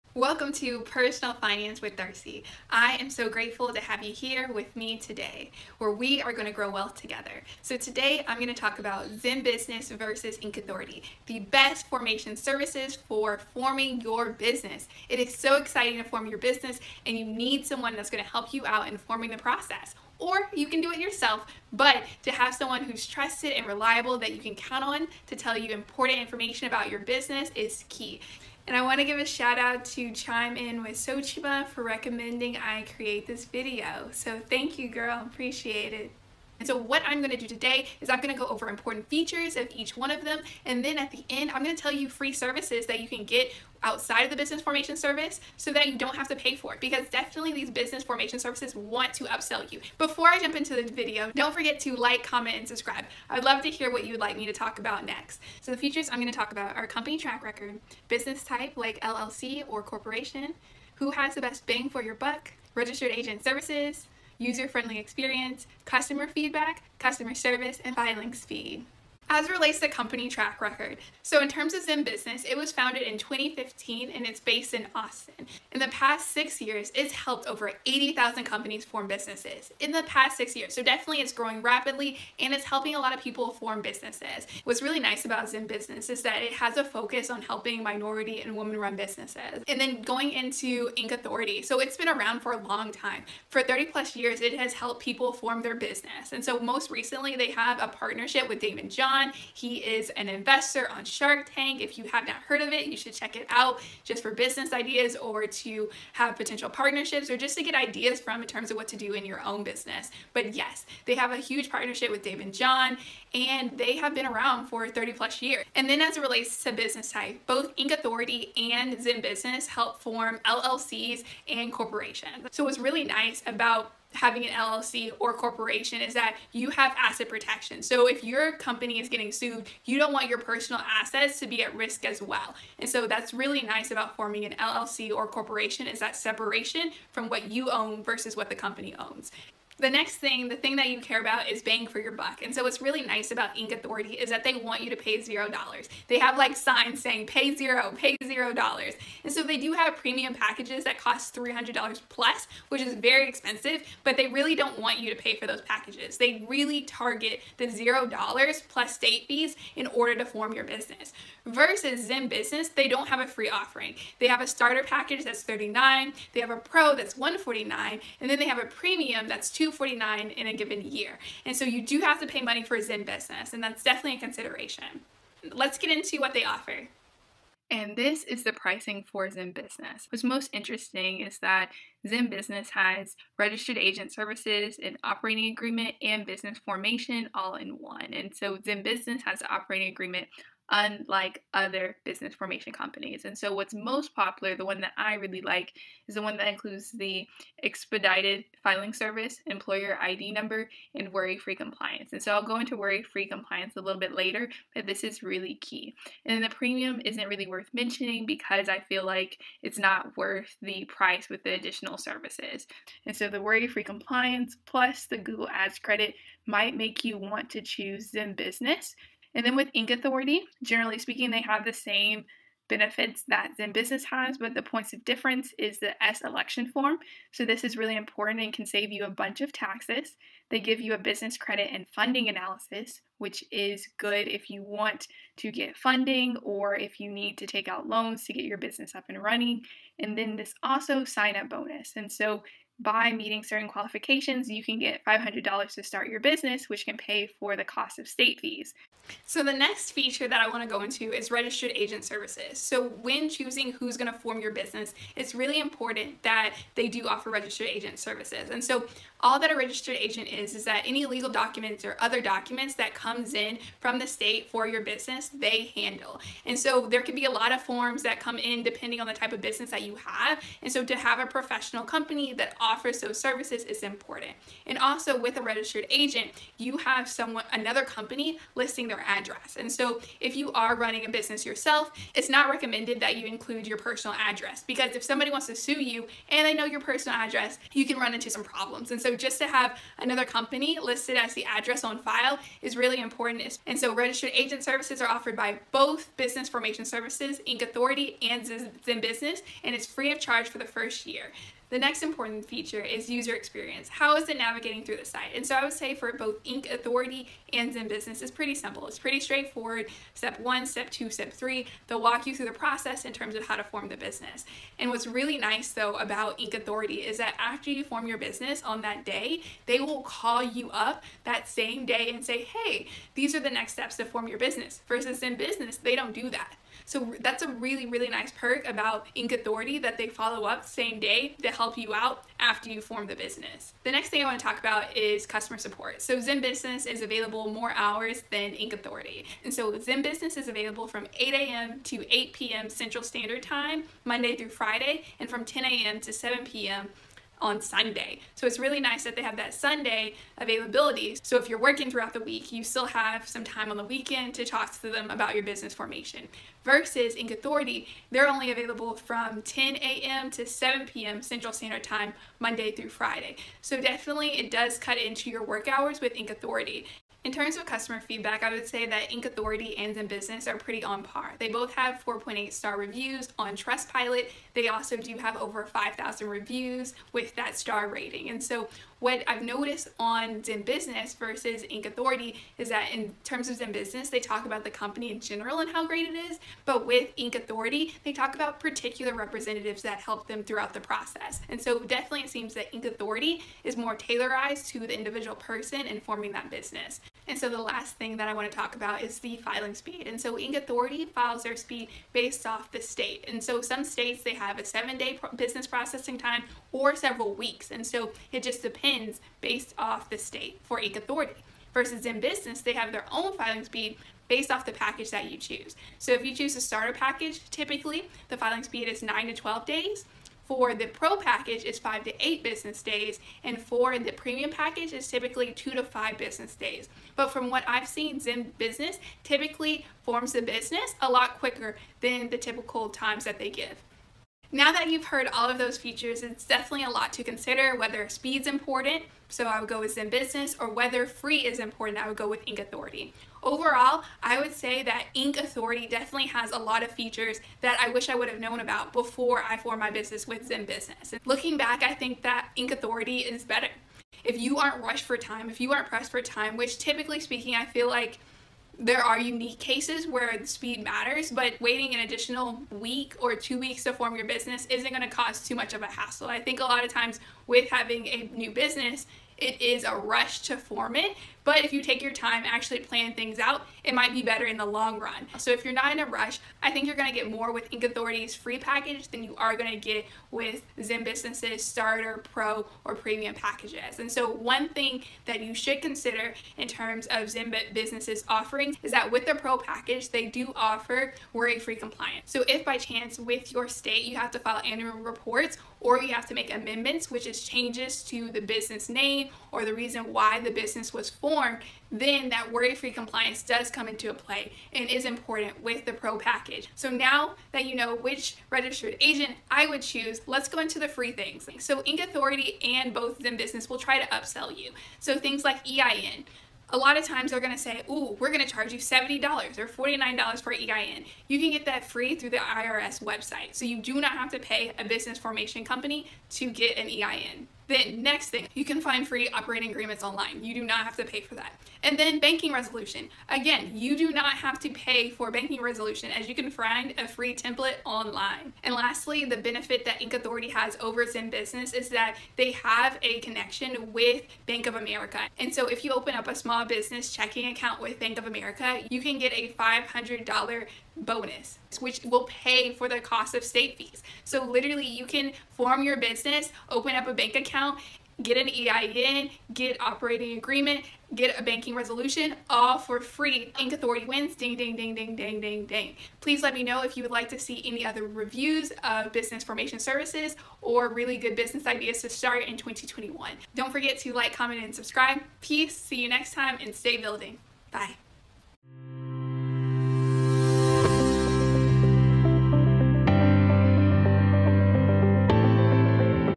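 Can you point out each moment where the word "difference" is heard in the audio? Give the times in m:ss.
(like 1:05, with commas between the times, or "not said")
3:45.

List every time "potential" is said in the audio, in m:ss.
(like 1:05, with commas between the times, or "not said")
1:46.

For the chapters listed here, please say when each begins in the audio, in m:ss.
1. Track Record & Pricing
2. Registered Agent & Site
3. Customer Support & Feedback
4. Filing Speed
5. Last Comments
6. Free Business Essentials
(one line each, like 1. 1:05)
1. 0:52
2. 4:10
3. 5:35
4. 6:37
5. 7:15
6. 8:30.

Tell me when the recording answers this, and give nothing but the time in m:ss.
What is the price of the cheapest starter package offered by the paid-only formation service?
2:45.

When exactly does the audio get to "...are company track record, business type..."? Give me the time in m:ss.
0:56.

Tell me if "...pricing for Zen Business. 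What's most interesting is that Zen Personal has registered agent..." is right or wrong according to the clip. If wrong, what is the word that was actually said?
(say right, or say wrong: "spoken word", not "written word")
wrong: "Business", not "Personal".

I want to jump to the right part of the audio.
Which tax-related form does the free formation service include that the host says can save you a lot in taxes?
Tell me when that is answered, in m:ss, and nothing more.
3:46.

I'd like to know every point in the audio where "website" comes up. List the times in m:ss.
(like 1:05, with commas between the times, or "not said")
8:43.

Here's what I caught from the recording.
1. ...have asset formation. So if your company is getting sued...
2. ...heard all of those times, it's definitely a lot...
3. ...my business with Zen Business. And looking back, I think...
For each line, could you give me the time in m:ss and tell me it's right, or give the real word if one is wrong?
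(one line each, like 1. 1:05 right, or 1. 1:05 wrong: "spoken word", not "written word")
1. 2:06 wrong: "protection", not "formation"
2. 7:15 wrong: "features", not "times"
3. 7:29 right.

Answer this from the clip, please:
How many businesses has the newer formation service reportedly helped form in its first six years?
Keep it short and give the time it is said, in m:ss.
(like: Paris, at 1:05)
80,000, at 1:17.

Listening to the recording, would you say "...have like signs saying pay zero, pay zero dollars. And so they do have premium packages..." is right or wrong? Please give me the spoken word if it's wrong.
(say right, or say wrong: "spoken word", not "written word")
right.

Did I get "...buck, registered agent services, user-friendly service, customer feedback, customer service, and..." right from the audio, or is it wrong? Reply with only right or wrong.
wrong.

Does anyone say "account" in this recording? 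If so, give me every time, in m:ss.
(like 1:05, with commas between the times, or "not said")
9:07, 9:17.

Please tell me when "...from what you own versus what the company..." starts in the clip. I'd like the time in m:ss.
2:17.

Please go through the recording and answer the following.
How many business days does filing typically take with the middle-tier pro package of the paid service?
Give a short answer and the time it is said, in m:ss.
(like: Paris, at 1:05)
5 to 8, at 7:01.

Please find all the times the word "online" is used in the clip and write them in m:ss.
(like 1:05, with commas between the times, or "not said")
8:50, 8:57.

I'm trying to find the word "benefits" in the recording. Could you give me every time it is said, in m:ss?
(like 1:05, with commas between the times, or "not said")
3:42, 8:59.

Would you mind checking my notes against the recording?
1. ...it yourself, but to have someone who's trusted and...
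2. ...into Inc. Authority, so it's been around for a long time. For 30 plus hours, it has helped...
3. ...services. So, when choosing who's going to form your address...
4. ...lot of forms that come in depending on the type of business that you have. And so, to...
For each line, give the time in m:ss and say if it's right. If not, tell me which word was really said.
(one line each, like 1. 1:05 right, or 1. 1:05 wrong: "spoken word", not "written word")
1. 0:20 right
2. 1:30 wrong: "years", not "hours"
3. 4:12 wrong: "business", not "address"
4. 4:27 right.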